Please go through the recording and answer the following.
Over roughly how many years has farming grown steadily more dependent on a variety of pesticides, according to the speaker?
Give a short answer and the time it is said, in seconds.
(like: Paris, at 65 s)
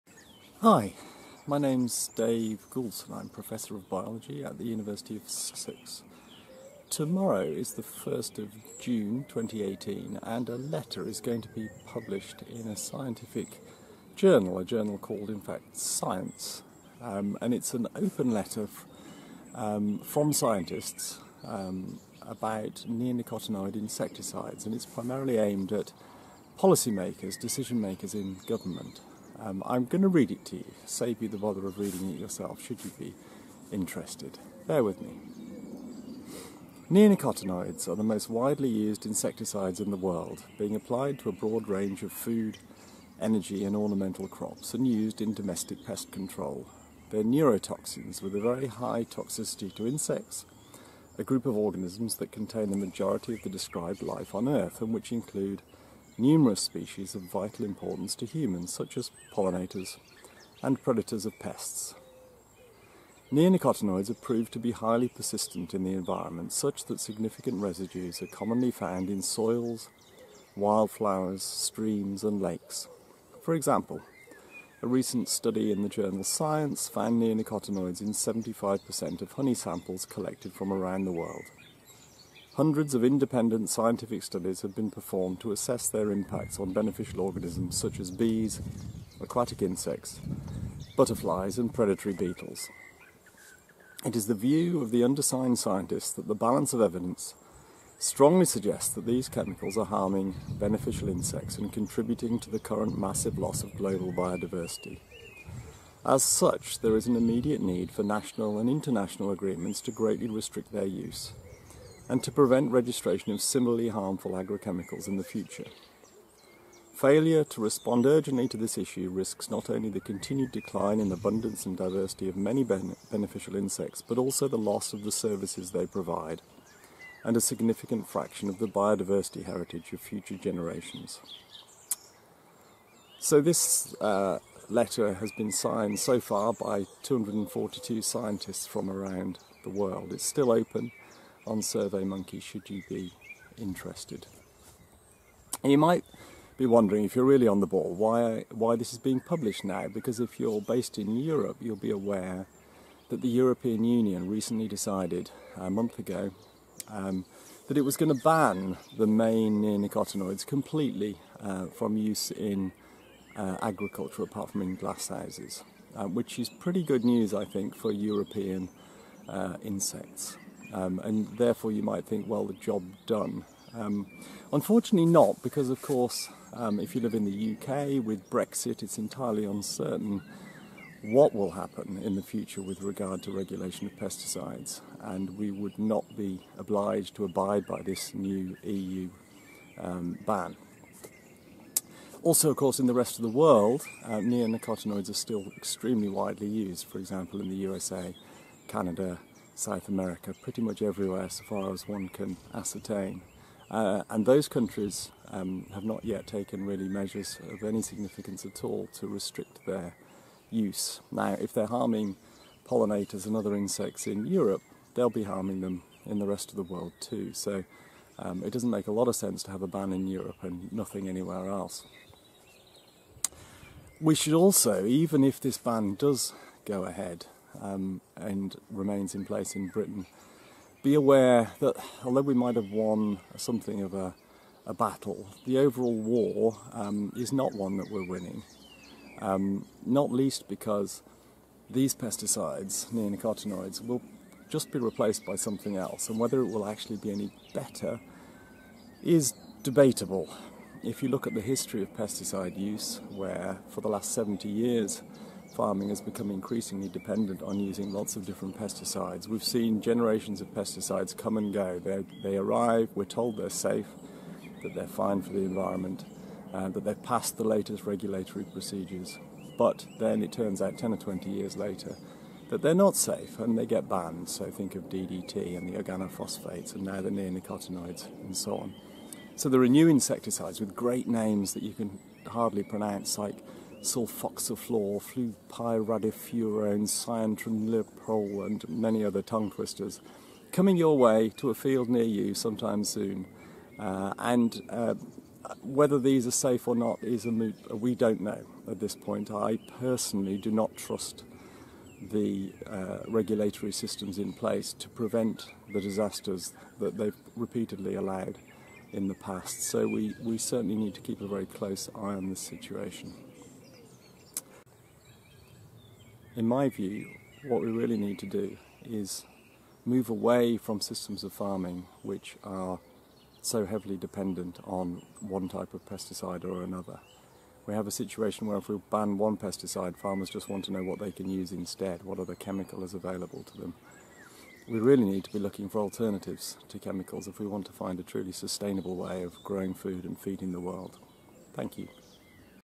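70 years, at 254 s.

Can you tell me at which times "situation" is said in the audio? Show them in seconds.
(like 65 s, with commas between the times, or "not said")
312 s, 327 s.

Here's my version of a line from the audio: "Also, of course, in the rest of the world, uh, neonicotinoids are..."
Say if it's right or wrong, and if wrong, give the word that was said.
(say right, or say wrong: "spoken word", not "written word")
right.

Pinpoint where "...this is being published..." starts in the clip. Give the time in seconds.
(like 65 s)
148 s.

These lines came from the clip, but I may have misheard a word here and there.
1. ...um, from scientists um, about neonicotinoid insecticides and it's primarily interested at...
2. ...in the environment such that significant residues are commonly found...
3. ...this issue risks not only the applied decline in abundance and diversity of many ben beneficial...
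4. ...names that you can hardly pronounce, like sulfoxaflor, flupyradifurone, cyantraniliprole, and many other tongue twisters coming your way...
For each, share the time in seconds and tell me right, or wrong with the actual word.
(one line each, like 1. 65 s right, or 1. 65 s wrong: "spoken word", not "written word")
1. 19 s wrong: "aimed", not "interested"
2. 65 s right
3. 118 s wrong: "continued", not "applied"
4. 281 s right.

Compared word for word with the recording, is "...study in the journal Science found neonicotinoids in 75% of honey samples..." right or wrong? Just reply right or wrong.
right.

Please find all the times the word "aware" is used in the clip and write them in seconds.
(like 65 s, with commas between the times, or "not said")
151 s, 230 s.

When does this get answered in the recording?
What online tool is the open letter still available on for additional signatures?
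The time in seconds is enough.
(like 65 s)
141 s.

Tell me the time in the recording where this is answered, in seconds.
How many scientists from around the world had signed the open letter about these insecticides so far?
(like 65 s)
137 s.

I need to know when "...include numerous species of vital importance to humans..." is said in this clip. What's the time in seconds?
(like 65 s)
55 s.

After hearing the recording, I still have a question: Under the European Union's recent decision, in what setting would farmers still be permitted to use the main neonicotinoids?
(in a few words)
glasshouses.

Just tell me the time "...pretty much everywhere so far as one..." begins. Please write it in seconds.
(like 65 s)
200 s.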